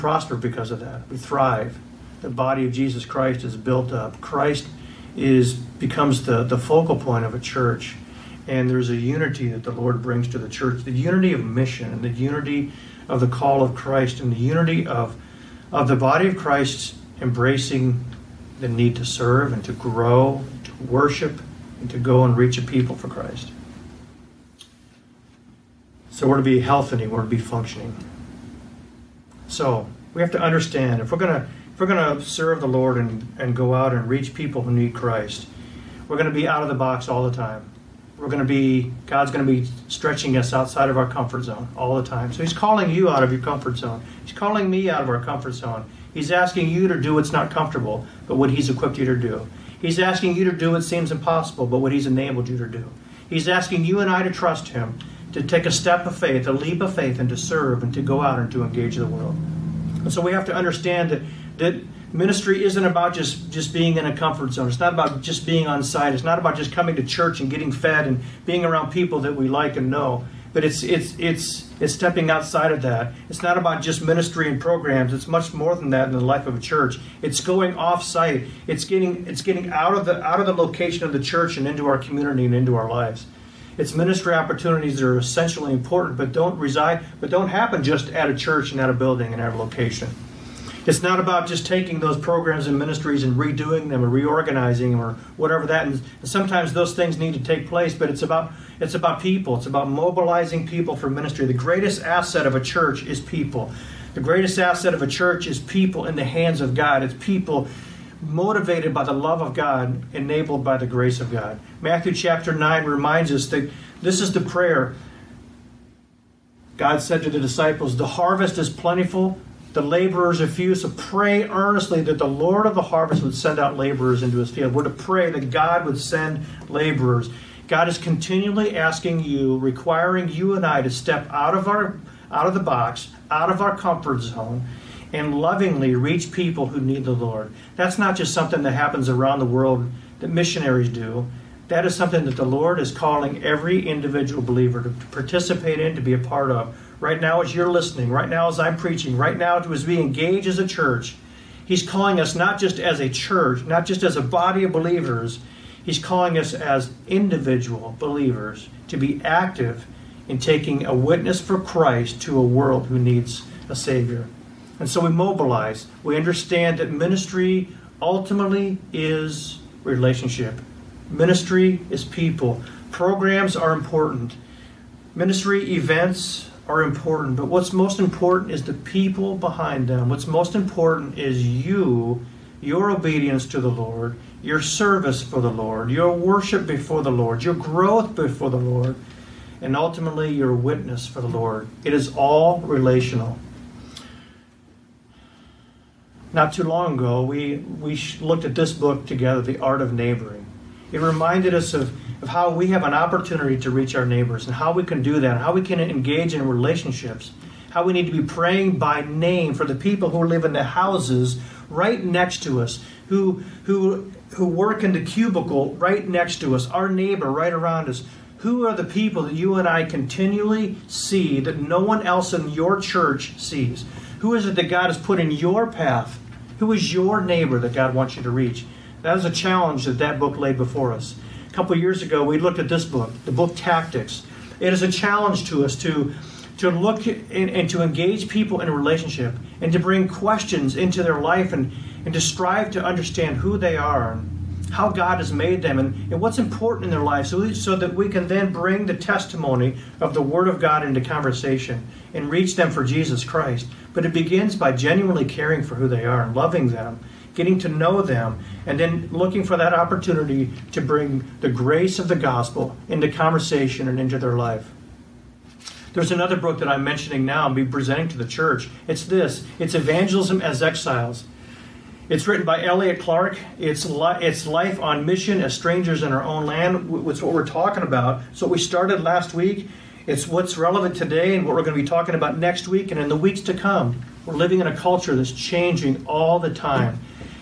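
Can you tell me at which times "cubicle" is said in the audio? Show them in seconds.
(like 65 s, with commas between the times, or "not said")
215 s.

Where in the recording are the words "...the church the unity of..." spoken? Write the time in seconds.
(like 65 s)
10 s.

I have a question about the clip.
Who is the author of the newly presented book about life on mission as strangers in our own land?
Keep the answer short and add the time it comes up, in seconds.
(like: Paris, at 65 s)
Elliot Clark, at 272 s.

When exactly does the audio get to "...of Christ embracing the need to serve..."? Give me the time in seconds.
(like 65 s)
16 s.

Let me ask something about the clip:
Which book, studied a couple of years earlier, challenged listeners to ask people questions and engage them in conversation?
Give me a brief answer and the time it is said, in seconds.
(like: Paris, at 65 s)
Tactics, at 233 s.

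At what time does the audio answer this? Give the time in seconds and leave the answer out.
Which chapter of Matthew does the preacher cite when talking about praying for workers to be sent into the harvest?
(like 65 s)
111 s.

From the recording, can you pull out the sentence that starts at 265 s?
There's another book that I'm mentioning now and be presenting to the church.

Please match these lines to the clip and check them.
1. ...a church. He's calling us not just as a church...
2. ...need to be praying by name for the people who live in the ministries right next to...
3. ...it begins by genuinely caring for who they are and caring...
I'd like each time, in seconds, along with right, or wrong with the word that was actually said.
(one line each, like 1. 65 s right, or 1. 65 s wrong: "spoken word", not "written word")
1. 150 s right
2. 207 s wrong: "houses", not "ministries"
3. 254 s wrong: "loving", not "caring".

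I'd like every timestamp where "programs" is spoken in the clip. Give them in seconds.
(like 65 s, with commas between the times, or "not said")
74 s, 92 s, 172 s.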